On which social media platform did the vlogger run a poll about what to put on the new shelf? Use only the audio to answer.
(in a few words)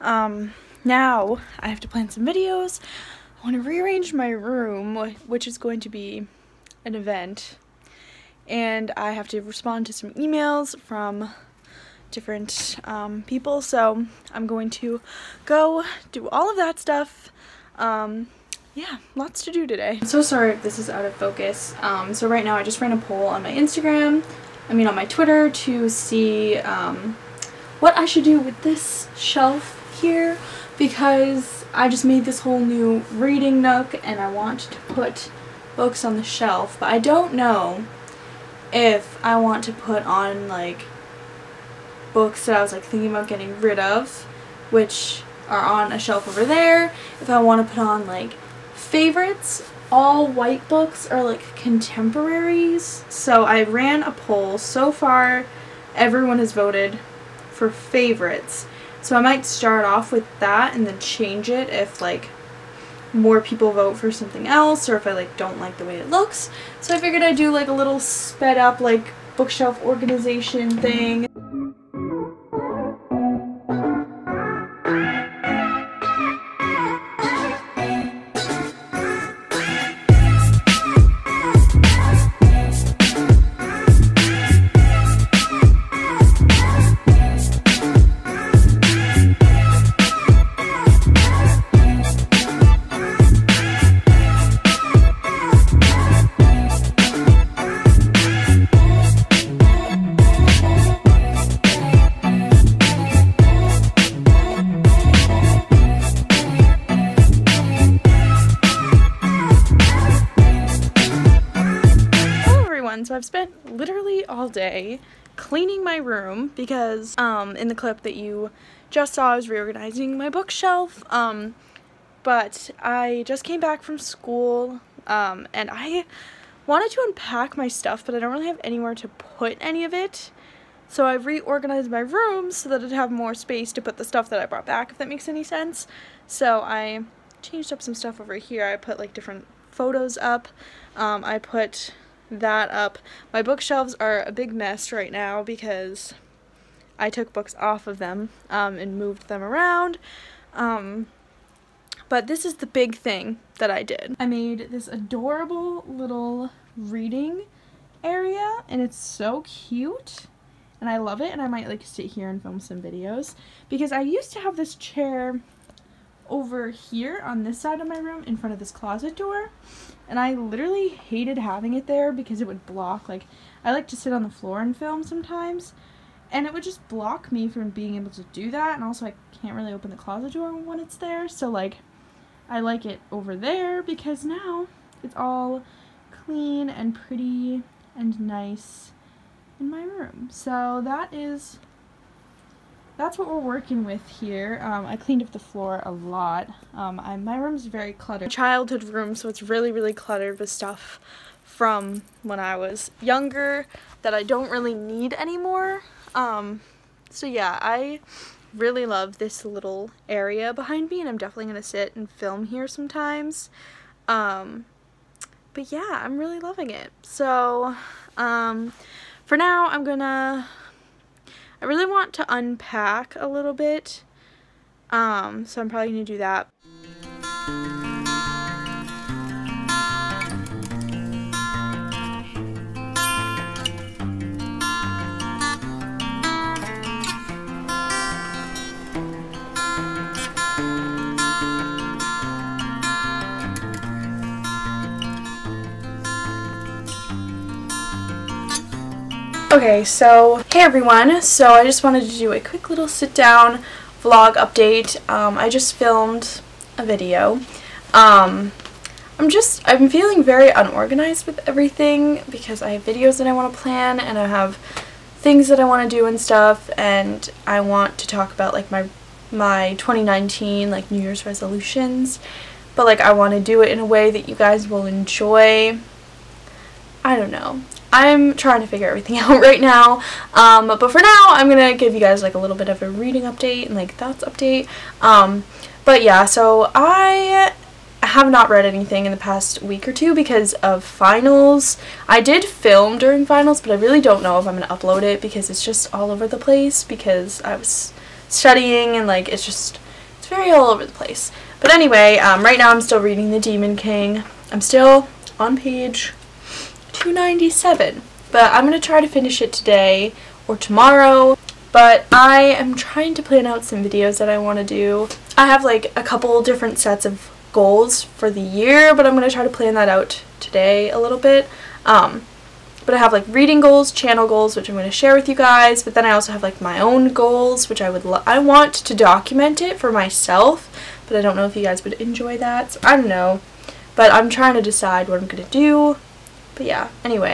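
Twitter.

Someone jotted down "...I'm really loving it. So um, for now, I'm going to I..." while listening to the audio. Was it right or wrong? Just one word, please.
right.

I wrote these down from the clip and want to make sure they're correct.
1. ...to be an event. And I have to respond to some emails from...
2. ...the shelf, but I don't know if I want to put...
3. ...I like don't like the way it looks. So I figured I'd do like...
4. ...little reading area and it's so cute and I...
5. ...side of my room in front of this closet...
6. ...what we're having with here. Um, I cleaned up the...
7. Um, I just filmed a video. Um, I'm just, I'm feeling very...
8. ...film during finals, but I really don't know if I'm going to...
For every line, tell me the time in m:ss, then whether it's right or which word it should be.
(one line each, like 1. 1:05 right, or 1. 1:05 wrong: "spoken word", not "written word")
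1. 0:05 right
2. 0:36 right
3. 1:05 right
4. 2:35 right
5. 2:47 right
6. 3:13 wrong: "working", not "having"
7. 4:15 right
8. 4:52 right.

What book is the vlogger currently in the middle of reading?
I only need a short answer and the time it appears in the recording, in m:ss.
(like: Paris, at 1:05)
The Demon King, at 5:03.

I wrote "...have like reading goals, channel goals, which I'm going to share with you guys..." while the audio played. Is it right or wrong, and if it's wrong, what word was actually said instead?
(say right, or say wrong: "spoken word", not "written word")
right.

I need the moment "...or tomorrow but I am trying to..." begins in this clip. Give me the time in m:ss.
5:10.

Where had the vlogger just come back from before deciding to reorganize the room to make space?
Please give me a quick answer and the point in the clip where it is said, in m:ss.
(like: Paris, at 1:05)
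School, at 2:03.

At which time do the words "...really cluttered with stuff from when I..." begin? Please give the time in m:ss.
3:19.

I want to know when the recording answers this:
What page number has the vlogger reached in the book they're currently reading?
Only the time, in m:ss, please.
5:05.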